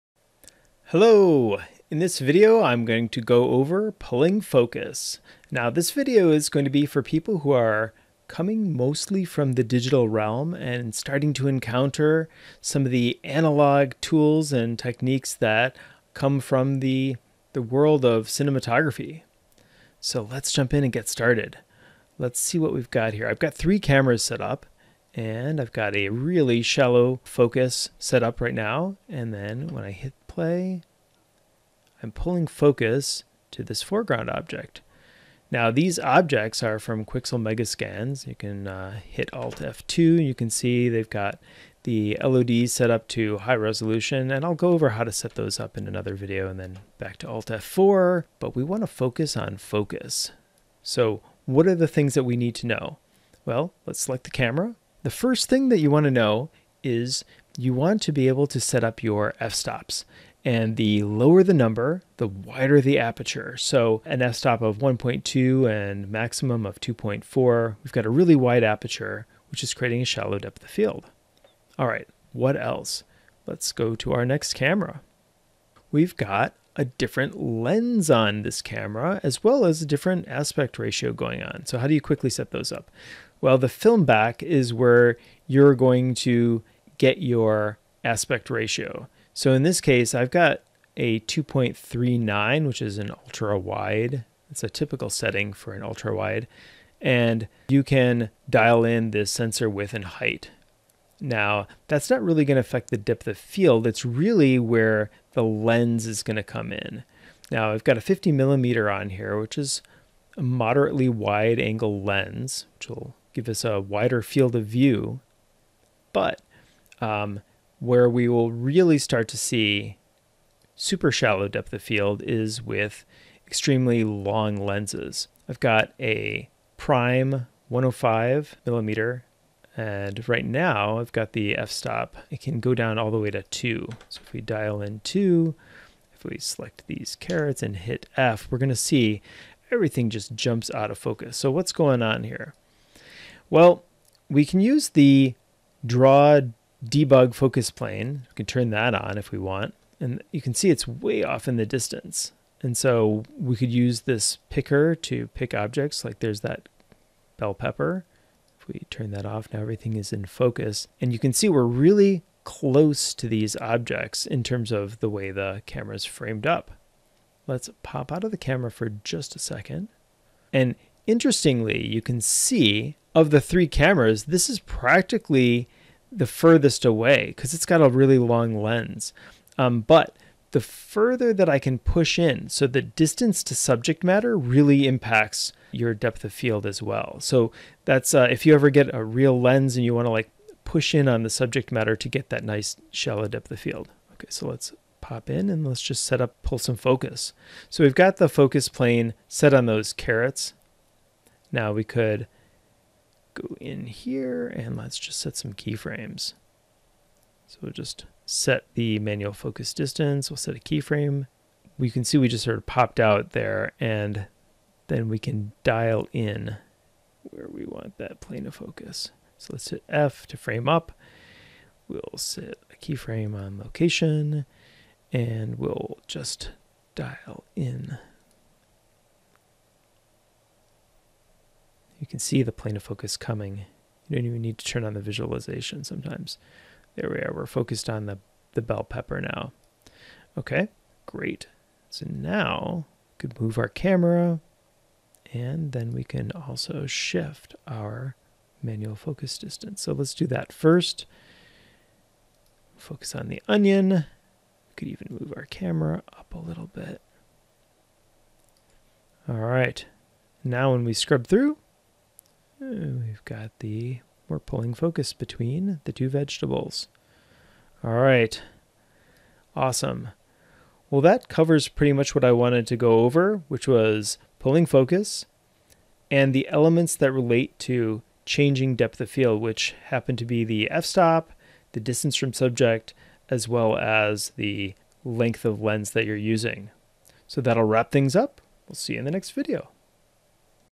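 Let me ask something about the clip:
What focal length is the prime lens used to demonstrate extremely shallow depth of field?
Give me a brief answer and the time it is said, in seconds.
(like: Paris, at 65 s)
105 millimeter, at 127 s.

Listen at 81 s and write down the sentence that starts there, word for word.
So how do you quickly set those up?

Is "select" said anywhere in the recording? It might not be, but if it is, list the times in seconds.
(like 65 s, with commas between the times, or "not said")
53 s, 136 s.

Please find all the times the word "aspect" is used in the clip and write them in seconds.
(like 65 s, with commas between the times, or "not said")
80 s, 88 s.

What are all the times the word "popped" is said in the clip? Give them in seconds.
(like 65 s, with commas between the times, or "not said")
212 s.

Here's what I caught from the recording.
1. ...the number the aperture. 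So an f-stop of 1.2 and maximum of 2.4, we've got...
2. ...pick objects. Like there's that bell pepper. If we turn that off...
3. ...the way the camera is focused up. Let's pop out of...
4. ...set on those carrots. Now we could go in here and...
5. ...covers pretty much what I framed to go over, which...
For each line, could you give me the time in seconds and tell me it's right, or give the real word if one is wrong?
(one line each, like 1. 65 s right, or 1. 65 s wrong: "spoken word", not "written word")
1. 62 s wrong: "wider", not "number"
2. 155 s right
3. 164 s wrong: "framed", not "focused"
4. 199 s right
5. 271 s wrong: "wanted", not "framed".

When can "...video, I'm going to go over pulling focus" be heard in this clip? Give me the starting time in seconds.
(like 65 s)
2 s.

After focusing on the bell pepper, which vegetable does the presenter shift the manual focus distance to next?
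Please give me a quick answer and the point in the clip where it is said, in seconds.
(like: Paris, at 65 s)
the onion, at 253 s.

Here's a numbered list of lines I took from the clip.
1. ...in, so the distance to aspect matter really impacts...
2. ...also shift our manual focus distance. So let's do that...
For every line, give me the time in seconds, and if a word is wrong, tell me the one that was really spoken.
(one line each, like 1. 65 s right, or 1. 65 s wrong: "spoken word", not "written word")
1. 182 s wrong: "subject", not "aspect"
2. 246 s right.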